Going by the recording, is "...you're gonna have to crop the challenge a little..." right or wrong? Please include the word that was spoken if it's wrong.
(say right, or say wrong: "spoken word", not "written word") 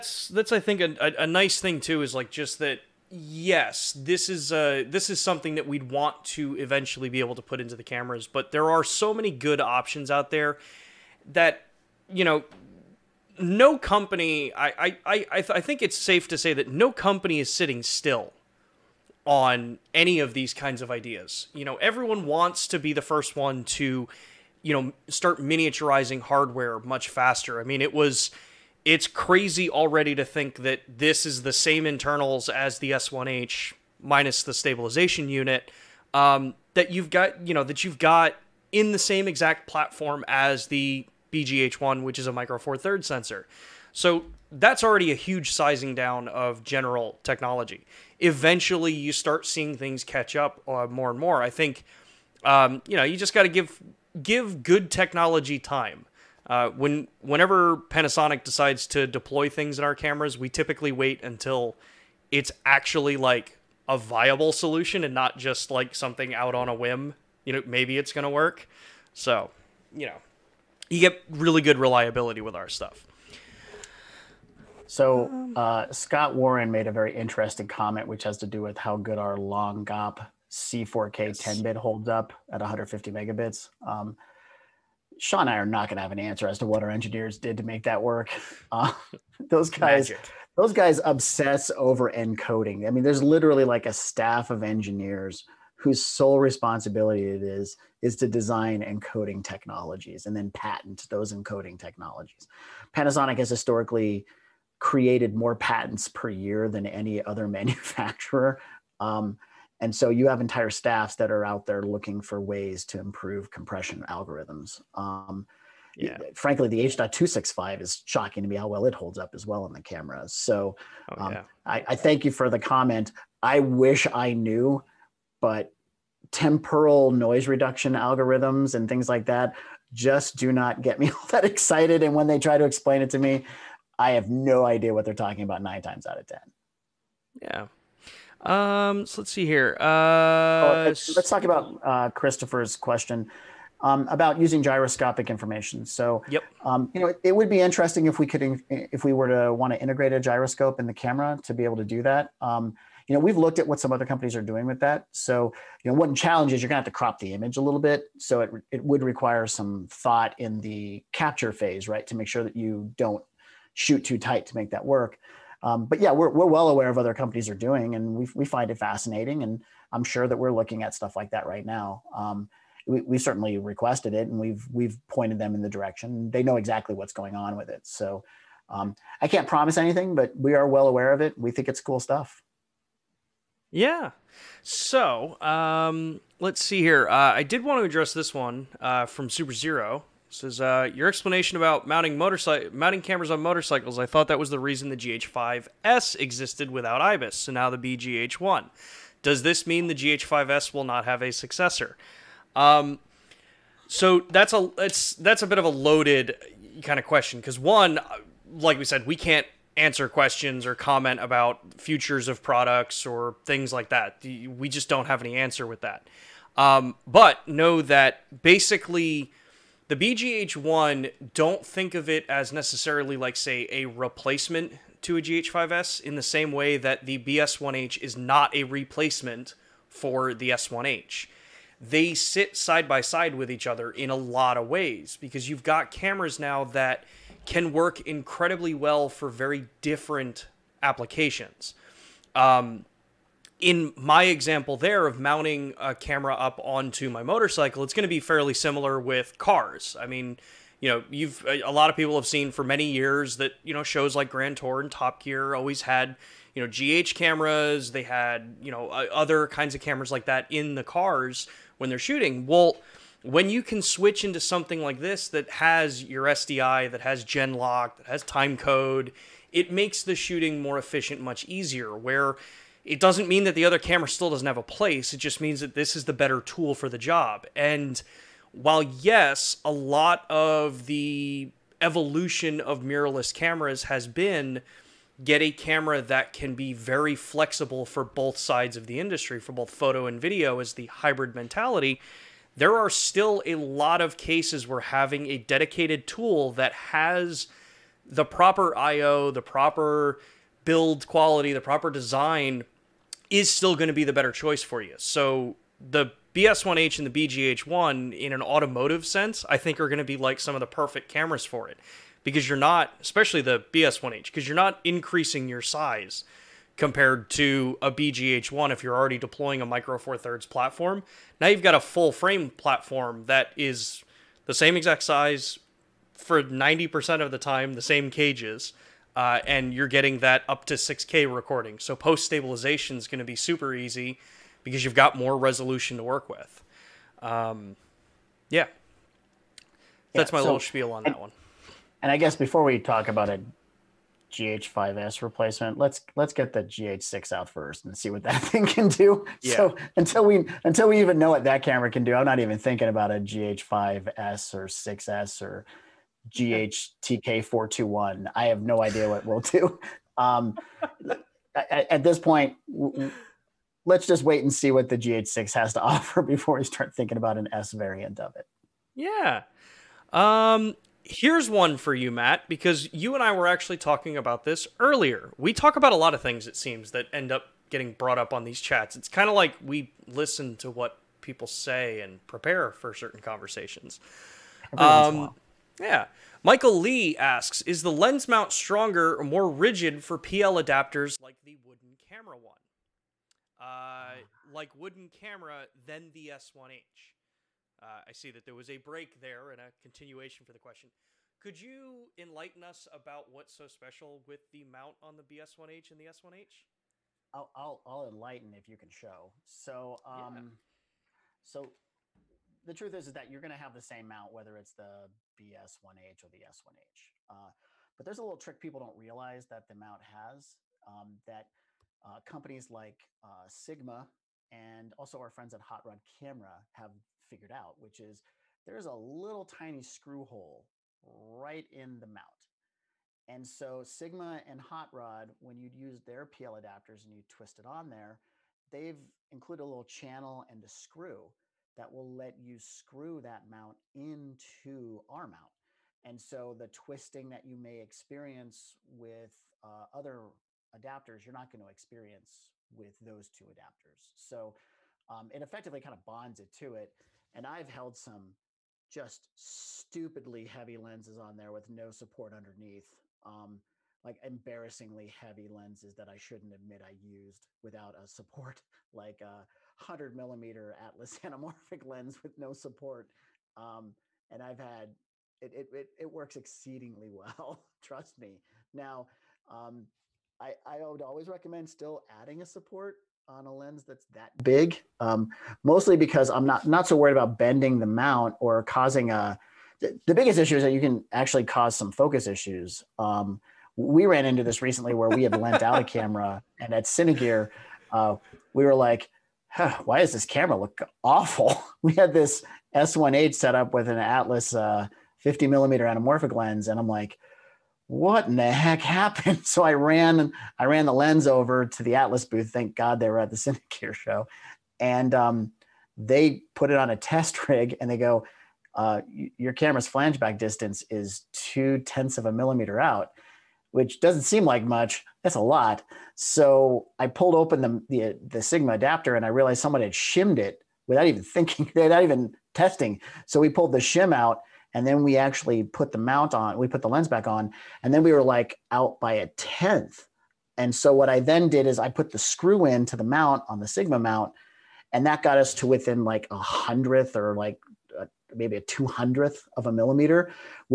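wrong: "image", not "challenge".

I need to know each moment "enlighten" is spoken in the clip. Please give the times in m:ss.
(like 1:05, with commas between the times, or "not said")
6:42, 6:48.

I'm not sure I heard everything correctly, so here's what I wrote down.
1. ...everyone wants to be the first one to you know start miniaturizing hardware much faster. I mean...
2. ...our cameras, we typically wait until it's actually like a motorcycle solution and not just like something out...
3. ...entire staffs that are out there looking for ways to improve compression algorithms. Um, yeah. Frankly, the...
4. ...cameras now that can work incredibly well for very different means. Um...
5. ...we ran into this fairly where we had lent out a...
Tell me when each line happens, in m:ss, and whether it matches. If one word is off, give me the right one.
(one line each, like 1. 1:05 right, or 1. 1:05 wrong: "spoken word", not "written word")
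1. 0:21 right
2. 0:59 wrong: "viable", not "motorcycle"
3. 1:50 right
4. 3:55 wrong: "applications", not "means"
5. 8:13 wrong: "recently", not "fairly".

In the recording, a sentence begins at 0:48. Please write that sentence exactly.
Eventually, you start seeing things catch up uh, more and more.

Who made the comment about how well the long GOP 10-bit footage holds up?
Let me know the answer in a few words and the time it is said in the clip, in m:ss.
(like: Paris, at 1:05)
Scott Warren, at 1:15.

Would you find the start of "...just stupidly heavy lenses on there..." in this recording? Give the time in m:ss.
7:38.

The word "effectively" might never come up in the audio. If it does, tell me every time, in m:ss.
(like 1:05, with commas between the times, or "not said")
7:35.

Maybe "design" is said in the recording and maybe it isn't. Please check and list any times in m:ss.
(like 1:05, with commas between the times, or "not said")
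1:38, 5:01.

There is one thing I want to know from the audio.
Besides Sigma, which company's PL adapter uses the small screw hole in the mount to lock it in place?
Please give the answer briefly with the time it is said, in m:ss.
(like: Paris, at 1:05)
Hot Rod Camera, at 7:05.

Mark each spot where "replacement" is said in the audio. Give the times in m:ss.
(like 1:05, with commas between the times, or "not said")
3:43, 3:48, 5:45.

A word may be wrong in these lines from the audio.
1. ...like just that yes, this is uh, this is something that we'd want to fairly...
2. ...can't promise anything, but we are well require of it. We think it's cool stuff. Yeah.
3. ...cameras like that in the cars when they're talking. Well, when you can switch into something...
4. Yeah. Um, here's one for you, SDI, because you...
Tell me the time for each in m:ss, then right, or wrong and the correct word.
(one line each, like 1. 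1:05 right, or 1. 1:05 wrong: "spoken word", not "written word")
1. 0:02 wrong: "eventually", not "fairly"
2. 2:59 wrong: "aware", not "require"
3. 4:19 wrong: "shooting", not "talking"
4. 6:08 wrong: "Matt", not "SDI".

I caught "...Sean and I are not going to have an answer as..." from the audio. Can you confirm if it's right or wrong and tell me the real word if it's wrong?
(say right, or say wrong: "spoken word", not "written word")
right.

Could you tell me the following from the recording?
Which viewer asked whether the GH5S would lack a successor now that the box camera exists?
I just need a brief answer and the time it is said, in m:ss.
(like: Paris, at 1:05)
Super Zero, at 3:09.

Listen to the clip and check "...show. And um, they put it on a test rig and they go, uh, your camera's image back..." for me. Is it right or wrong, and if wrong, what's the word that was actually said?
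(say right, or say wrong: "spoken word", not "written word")
wrong: "flange", not "image".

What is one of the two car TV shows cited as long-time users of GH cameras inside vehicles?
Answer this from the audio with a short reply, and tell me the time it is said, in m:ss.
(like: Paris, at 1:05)
Grand Tour, at 4:14.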